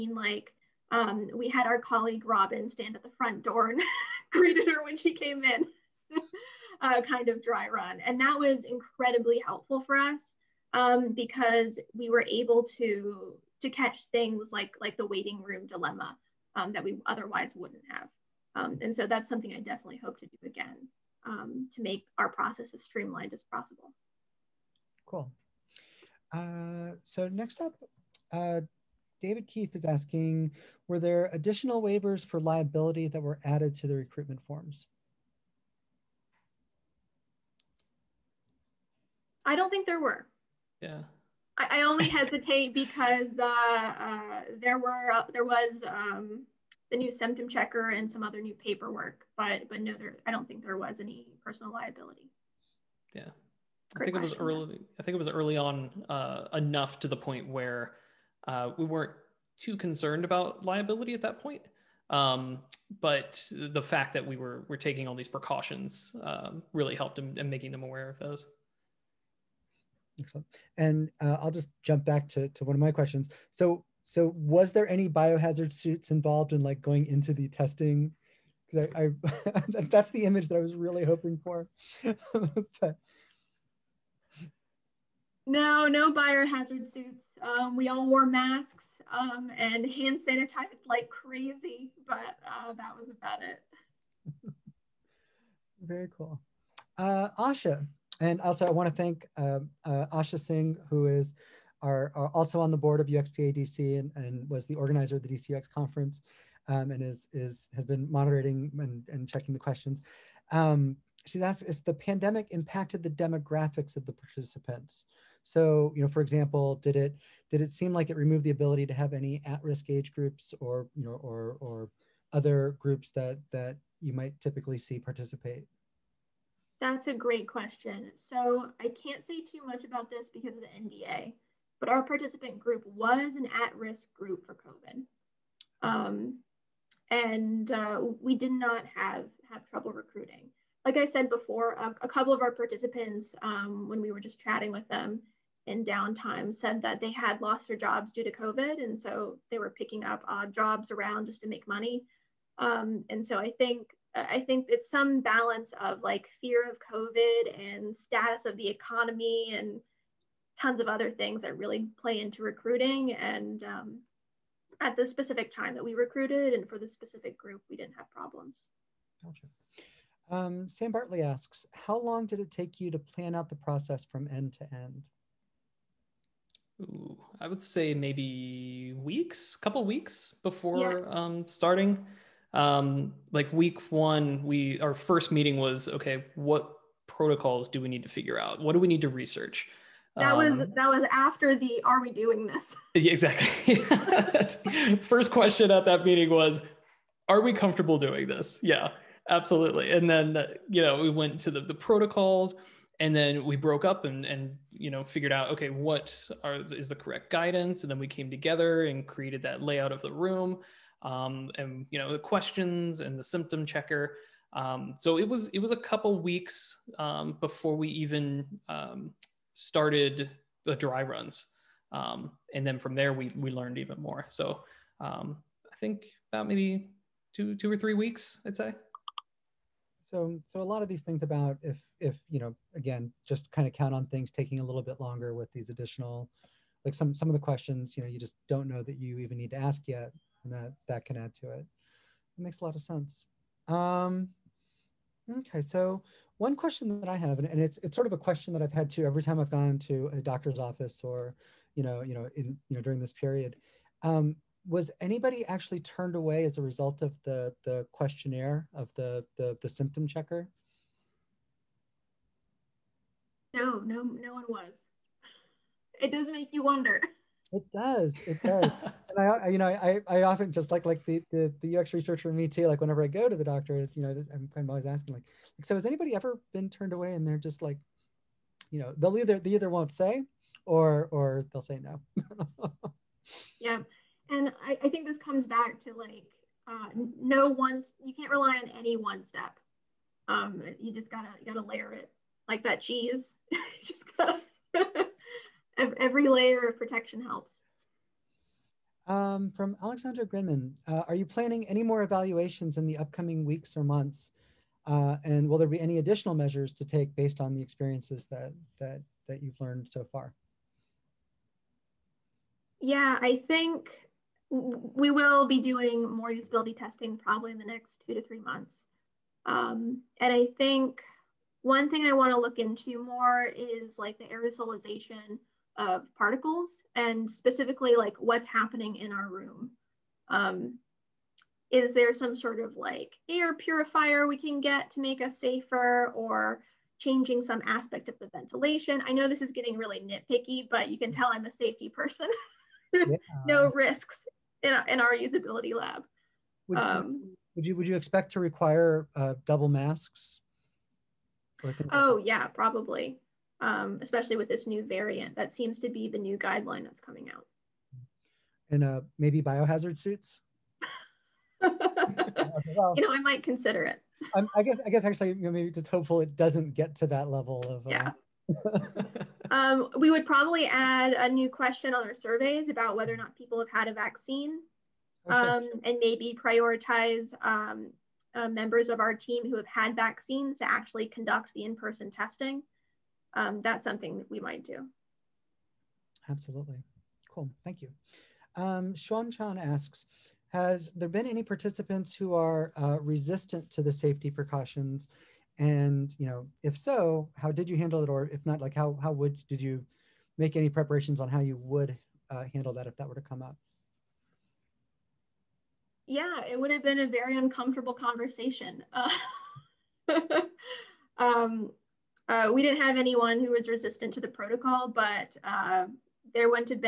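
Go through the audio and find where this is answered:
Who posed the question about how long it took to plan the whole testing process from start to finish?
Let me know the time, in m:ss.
2:50.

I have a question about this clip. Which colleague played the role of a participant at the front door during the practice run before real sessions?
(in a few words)
Robin.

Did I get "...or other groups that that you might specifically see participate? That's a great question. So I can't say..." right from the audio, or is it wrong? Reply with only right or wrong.
wrong.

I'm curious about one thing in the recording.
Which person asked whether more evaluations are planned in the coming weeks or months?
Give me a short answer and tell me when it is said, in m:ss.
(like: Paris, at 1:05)
Alexandra Grinman, at 4:59.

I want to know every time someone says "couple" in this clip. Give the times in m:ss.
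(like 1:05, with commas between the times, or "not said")
2:22, 2:59, 3:35.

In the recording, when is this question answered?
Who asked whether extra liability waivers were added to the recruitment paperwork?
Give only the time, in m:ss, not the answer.
0:29.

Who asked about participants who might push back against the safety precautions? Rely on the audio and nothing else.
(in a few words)
Chan.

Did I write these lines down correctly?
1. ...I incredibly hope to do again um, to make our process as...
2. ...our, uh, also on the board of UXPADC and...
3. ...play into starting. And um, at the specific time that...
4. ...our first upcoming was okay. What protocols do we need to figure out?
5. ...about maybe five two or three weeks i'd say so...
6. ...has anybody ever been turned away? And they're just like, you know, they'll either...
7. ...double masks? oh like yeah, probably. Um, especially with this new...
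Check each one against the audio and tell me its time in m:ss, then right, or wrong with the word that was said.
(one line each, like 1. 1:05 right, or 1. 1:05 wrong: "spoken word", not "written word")
1. 0:19 wrong: "definitely", not "incredibly"
2. 1:41 right
3. 2:42 wrong: "recruiting", not "starting"
4. 3:04 wrong: "meeting", not "upcoming"
5. 3:46 wrong: "two", not "five"
6. 4:35 right
7. 5:49 right.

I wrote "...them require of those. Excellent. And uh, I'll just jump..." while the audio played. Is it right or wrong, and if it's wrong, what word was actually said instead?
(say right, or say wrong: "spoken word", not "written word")
wrong: "aware", not "require".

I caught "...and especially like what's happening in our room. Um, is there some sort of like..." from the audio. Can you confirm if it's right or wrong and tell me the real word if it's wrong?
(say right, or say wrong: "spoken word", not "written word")
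wrong: "specifically", not "especially".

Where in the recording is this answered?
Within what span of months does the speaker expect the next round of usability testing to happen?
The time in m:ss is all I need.
5:18.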